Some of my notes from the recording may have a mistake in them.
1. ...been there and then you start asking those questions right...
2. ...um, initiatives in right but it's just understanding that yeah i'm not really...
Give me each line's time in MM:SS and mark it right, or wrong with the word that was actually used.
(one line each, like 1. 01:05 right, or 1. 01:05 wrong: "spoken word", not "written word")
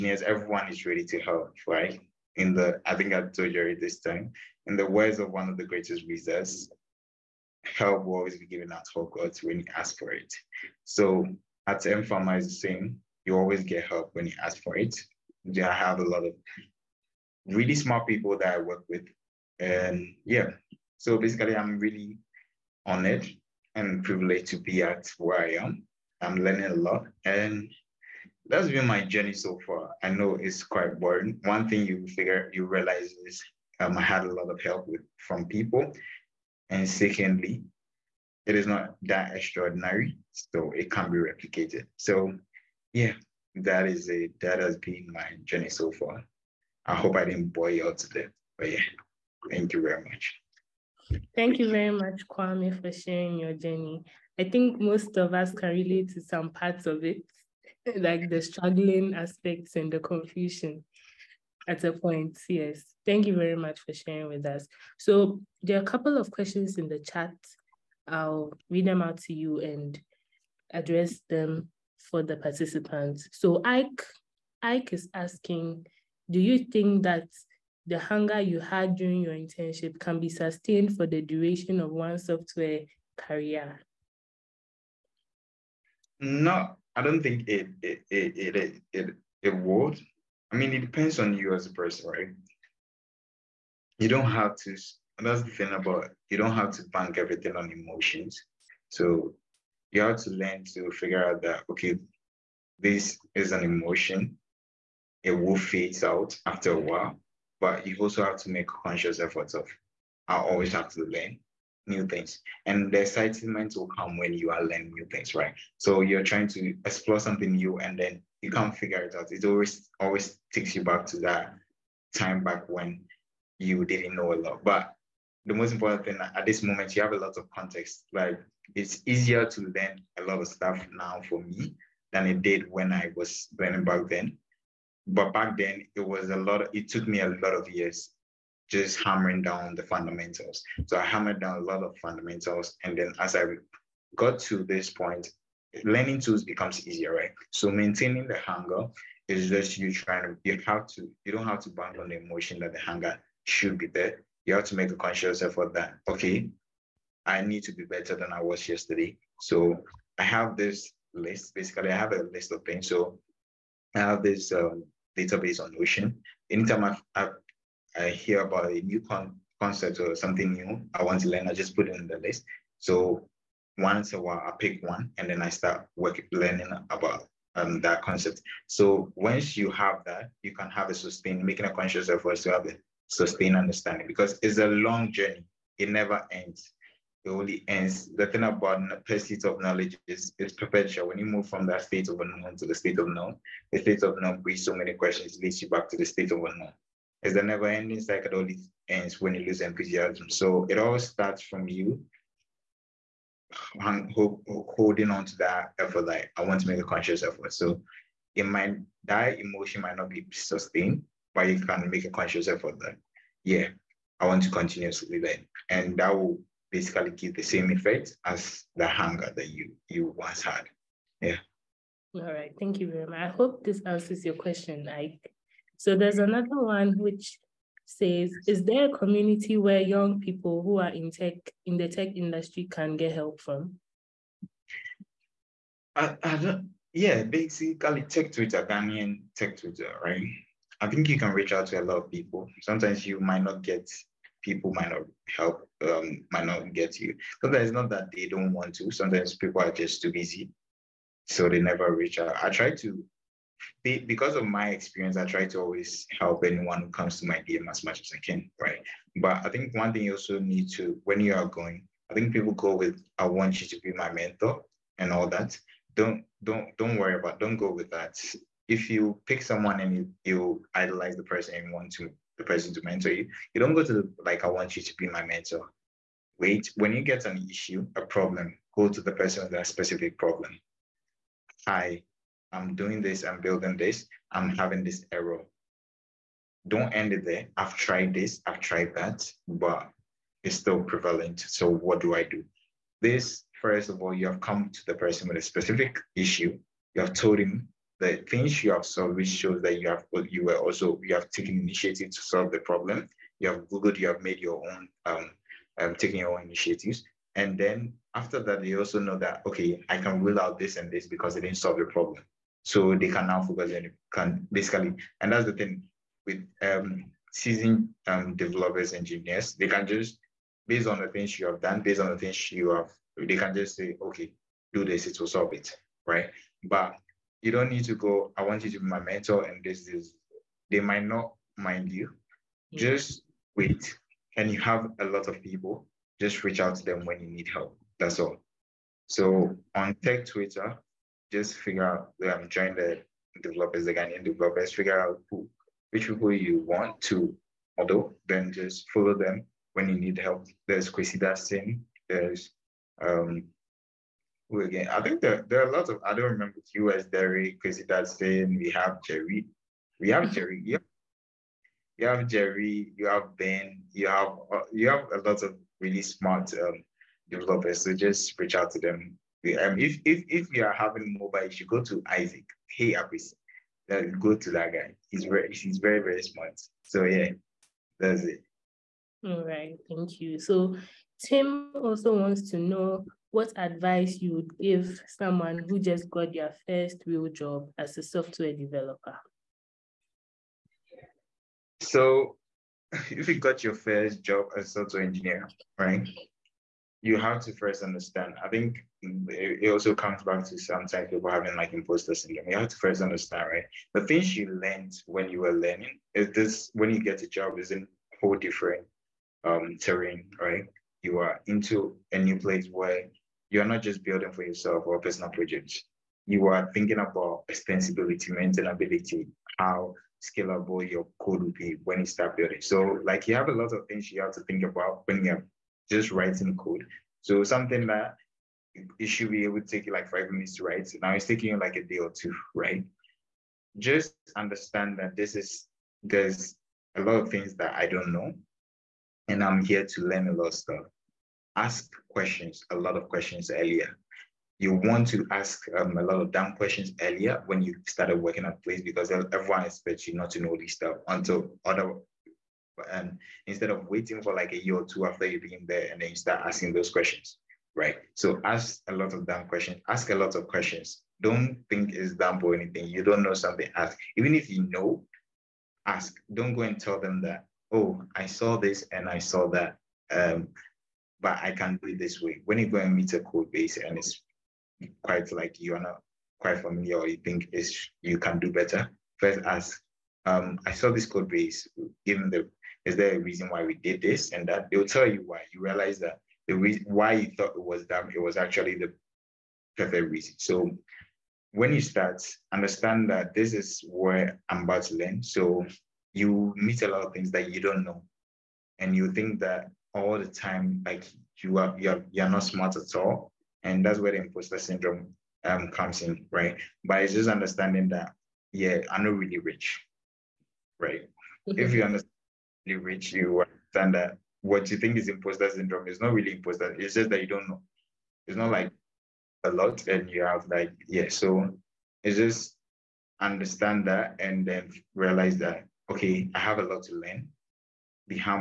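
1. 07:35 right
2. 08:25 wrong: "comes", not "initiatives".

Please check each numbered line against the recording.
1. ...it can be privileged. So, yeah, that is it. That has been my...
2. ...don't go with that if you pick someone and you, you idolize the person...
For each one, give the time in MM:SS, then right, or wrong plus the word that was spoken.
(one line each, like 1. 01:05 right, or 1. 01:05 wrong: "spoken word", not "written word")
1. 00:40 wrong: "replicated", not "privileged"
2. 04:27 right.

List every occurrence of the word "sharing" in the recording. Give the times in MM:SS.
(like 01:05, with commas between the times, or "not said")
00:52, 01:03.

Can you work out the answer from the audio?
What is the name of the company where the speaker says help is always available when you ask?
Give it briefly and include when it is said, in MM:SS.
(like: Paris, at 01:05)
M Pharma, at 00:11.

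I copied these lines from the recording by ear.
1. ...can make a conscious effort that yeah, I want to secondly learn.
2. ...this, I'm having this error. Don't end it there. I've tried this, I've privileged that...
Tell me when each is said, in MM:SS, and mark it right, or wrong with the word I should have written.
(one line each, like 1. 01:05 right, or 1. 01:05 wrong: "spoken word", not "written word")
1. 03:31 wrong: "continuously", not "secondly"
2. 04:43 wrong: "tried", not "privileged".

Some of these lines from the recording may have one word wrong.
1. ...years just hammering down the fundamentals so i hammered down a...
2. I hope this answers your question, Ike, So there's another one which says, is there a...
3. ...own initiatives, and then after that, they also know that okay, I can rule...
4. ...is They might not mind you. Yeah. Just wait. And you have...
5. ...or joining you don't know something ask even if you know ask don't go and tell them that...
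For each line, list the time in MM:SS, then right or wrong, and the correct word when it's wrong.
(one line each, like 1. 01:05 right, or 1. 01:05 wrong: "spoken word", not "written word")
1. 02:17 right
2. 03:43 right
3. 05:06 right
4. 05:29 right
5. 07:42 wrong: "anything", not "joining".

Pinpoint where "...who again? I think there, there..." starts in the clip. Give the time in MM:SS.
05:54.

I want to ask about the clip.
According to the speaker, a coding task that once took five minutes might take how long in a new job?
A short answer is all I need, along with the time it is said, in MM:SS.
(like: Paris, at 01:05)
a day or two, at 07:11.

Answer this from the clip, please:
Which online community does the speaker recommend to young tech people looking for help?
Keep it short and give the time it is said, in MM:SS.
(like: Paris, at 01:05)
Ghanaian tech Twitter, at 03:58.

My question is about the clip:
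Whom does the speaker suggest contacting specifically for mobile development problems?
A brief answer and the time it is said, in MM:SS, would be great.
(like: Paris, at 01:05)
Isaac, at 06:12.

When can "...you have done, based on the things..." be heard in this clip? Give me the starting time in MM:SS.
05:21.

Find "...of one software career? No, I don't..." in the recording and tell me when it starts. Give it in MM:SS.
01:21.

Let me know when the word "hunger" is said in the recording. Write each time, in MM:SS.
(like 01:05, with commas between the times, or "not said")
01:17, 02:28, 02:32, 03:38.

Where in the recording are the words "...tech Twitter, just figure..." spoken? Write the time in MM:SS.
05:40.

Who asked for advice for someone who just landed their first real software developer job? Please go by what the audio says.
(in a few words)
Tim.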